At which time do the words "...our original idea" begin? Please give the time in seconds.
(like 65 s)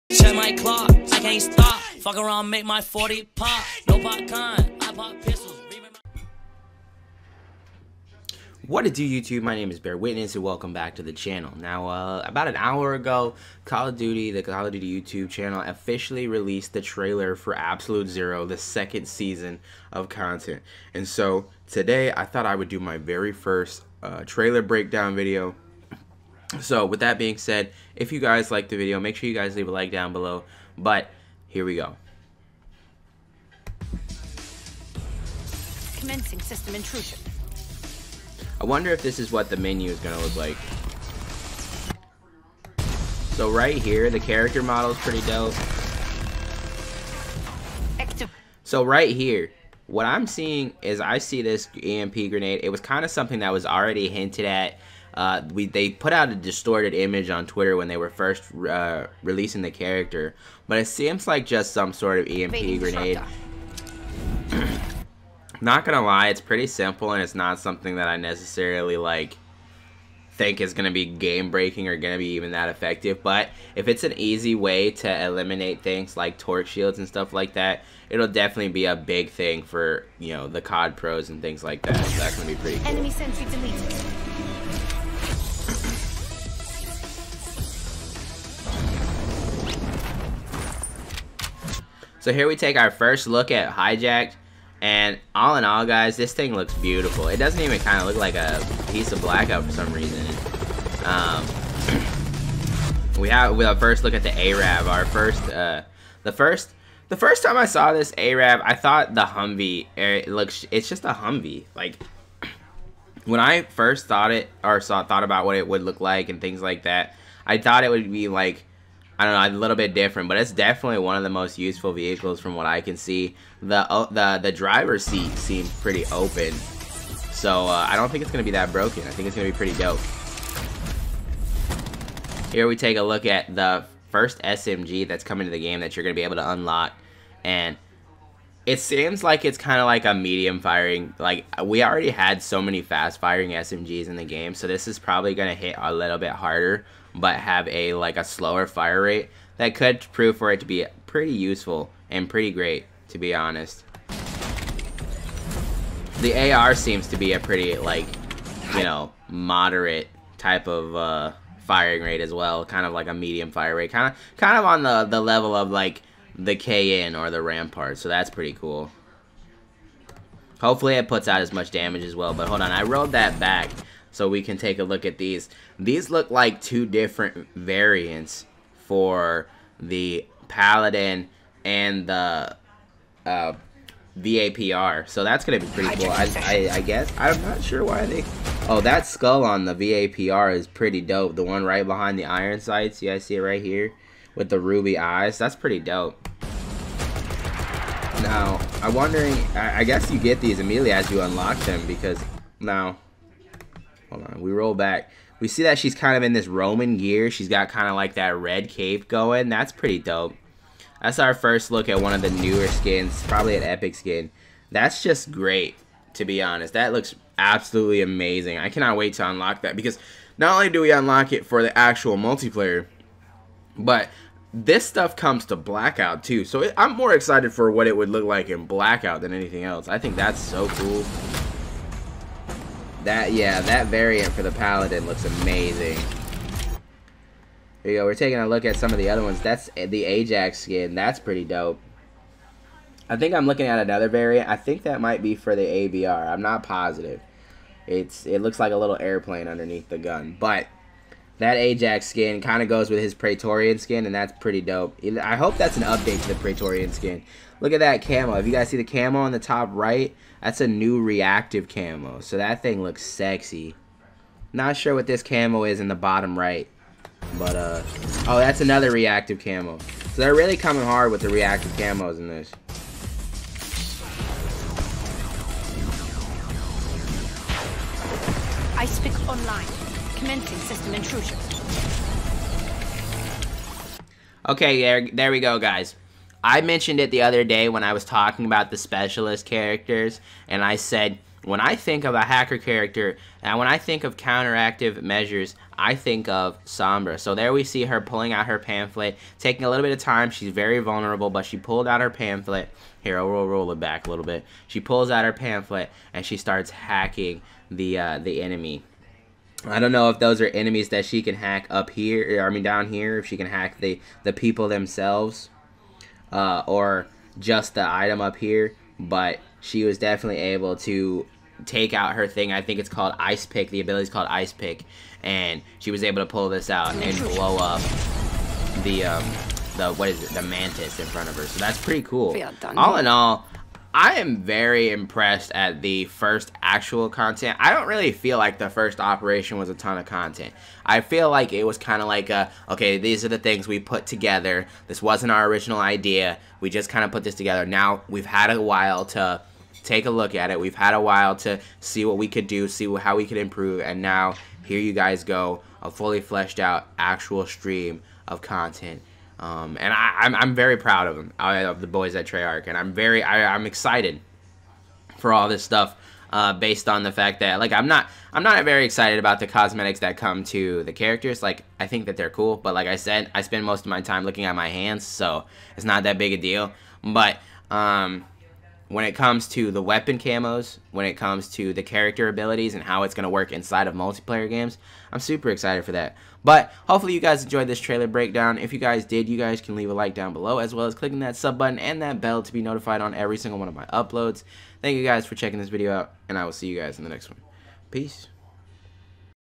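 345 s.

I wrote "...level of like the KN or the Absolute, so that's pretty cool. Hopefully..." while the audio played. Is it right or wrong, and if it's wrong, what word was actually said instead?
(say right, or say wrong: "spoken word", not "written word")
wrong: "Rampart", not "Absolute".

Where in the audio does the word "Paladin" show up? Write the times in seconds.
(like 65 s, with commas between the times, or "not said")
180 s, 234 s.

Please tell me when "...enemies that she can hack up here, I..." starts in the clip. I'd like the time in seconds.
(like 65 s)
310 s.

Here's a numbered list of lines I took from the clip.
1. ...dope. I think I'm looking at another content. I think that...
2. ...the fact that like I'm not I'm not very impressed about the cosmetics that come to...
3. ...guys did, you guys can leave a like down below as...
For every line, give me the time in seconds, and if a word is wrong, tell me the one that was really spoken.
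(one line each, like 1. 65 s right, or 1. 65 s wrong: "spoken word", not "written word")
1. 241 s wrong: "variant", not "content"
2. 367 s wrong: "excited", not "impressed"
3. 388 s right.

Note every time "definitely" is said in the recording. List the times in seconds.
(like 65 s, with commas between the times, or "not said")
78 s, 120 s, 319 s.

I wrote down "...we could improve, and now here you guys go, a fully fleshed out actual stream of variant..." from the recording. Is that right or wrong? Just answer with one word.
wrong.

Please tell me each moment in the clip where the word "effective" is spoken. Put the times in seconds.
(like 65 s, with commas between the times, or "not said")
72 s.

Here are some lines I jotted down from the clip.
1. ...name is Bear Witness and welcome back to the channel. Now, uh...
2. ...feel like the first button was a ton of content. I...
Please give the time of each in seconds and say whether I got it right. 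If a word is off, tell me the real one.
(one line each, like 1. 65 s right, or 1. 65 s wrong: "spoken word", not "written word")
1. 9 s right
2. 338 s wrong: "operation", not "button".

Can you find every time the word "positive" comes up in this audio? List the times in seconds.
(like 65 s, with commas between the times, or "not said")
246 s.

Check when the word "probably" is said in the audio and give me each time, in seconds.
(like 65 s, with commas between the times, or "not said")
144 s, 213 s.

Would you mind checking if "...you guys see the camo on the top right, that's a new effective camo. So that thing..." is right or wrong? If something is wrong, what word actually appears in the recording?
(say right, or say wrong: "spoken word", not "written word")
wrong: "reactive", not "effective".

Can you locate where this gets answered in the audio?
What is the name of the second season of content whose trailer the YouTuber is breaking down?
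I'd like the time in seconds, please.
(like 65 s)
17 s.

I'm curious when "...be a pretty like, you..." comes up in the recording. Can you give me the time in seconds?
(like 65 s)
157 s.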